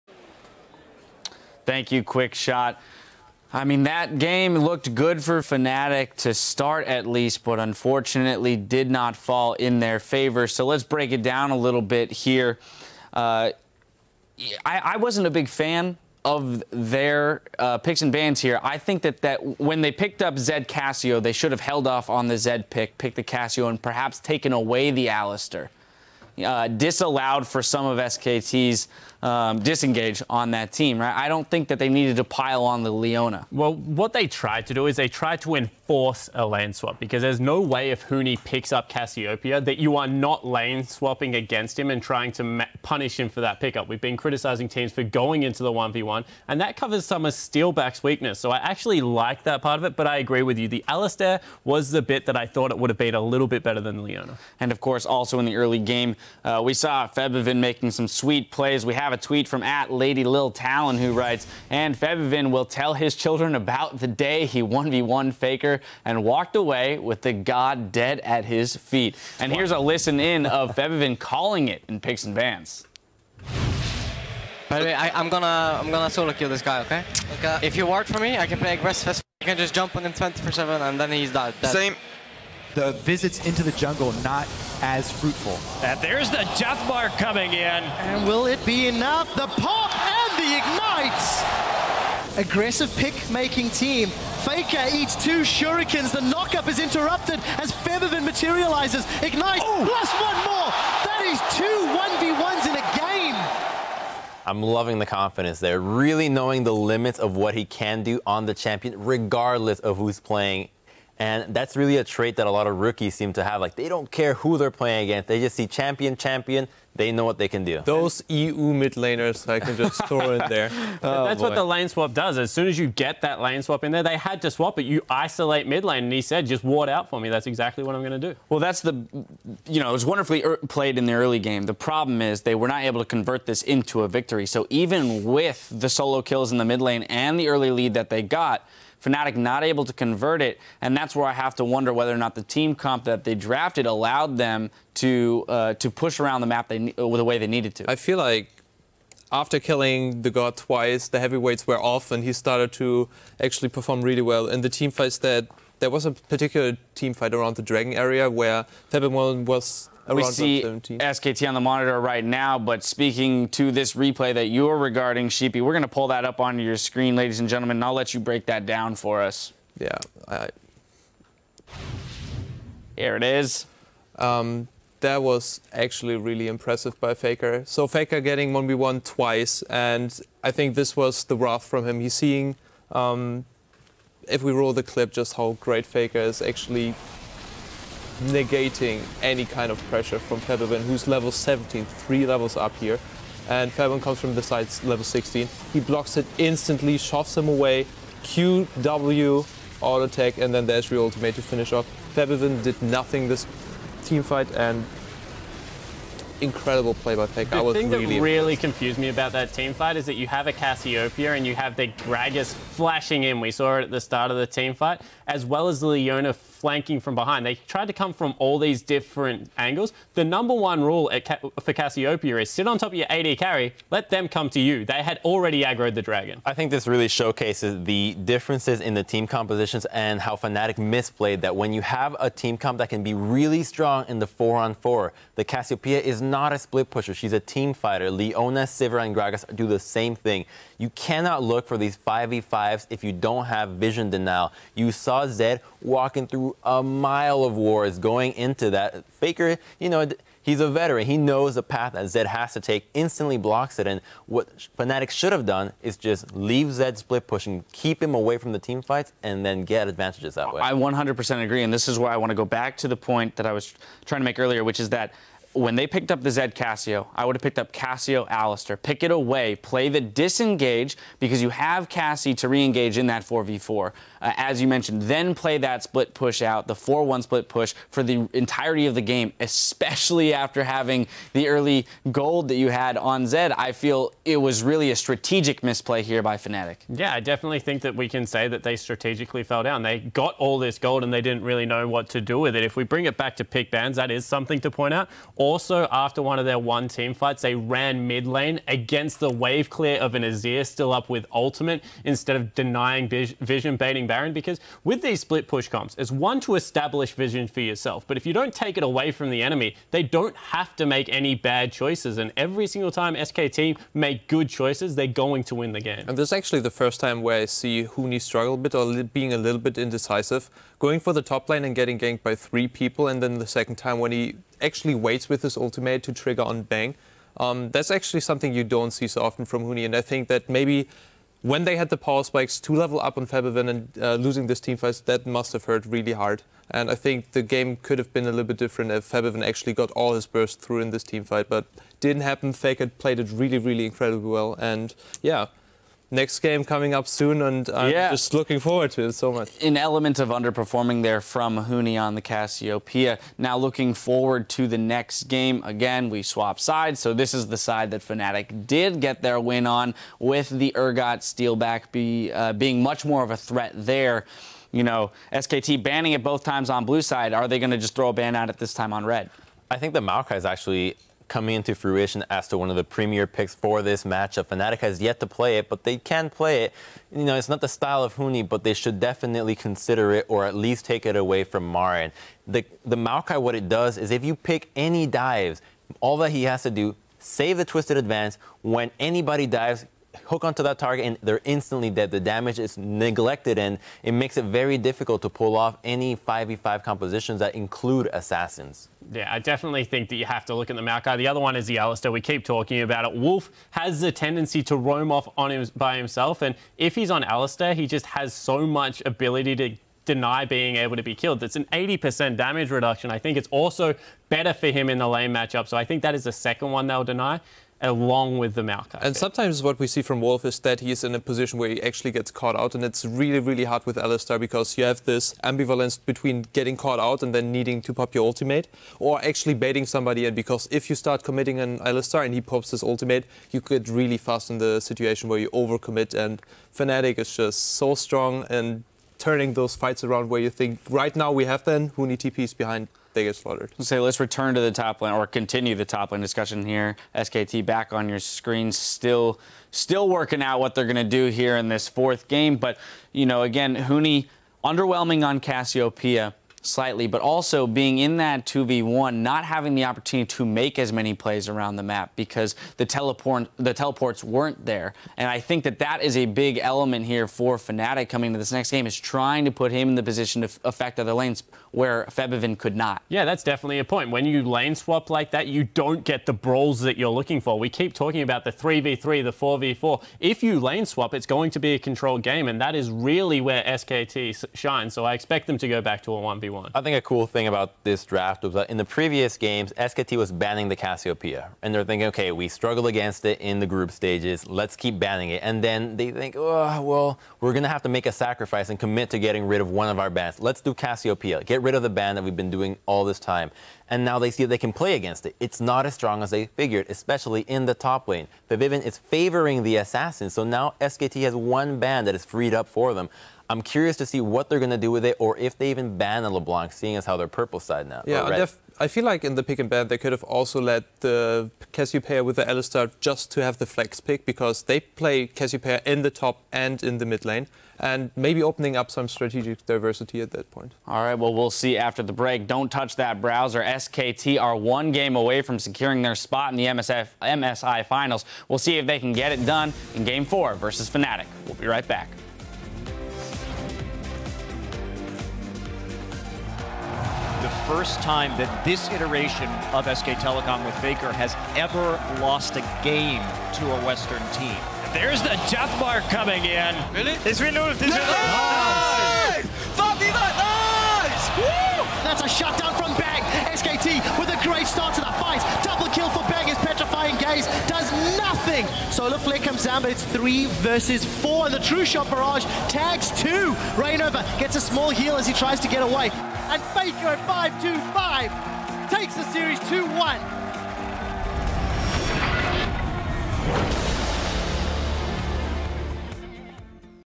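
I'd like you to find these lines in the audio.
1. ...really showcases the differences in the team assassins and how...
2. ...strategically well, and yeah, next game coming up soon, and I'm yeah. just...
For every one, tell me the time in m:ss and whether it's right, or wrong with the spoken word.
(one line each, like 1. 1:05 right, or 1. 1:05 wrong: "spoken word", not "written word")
1. 3:46 wrong: "compositions", not "assassins"
2. 5:43 wrong: "incredibly", not "strategically".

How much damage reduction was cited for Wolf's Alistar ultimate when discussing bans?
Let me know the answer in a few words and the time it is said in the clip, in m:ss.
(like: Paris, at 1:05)
80%, at 6:51.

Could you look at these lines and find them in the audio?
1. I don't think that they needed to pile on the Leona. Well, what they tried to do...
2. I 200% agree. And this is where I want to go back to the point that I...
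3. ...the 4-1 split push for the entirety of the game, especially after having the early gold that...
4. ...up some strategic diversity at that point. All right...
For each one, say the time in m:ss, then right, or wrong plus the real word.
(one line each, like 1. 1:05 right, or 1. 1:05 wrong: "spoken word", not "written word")
1. 0:31 right
2. 4:20 wrong: "100", not "200"
3. 4:36 right
4. 8:48 right.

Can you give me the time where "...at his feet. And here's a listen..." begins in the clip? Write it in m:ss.
1:08.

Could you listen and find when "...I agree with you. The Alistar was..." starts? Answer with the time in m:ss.
0:50.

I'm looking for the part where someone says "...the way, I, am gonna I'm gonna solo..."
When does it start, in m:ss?
1:14.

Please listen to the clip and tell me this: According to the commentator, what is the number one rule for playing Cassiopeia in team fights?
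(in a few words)
Sit on top of your AD carry.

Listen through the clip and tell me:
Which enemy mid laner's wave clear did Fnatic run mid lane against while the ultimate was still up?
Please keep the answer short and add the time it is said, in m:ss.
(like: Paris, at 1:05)
Azir, at 5:00.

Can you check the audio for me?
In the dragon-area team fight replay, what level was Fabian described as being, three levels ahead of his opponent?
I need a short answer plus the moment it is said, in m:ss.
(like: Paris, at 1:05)
17, at 3:11.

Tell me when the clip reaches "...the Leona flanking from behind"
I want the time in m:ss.
3:35.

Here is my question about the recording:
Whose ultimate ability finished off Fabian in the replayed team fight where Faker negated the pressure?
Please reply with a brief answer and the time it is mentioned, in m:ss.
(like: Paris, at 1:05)
Ezreal, at 3:20.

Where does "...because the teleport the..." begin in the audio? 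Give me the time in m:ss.
7:42.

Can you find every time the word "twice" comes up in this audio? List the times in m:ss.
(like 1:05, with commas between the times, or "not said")
2:30, 2:59.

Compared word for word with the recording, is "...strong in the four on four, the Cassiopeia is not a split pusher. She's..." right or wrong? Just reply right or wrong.
right.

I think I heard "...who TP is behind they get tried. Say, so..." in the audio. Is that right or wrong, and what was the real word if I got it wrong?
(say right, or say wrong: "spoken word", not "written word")
wrong: "slaughtered", not "tried".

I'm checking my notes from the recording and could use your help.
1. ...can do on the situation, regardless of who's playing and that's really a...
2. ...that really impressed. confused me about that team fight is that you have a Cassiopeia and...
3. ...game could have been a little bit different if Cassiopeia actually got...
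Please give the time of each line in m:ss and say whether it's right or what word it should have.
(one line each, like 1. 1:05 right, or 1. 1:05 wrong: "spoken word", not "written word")
1. 1:47 wrong: "champion", not "situation"
2. 3:28 right
3. 5:37 wrong: "Febiven", not "Cassiopeia".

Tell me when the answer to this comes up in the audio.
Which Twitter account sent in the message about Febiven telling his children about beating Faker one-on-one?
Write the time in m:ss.
0:59.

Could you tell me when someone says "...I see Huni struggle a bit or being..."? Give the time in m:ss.
5:17.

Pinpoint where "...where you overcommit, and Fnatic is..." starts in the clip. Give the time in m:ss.
7:15.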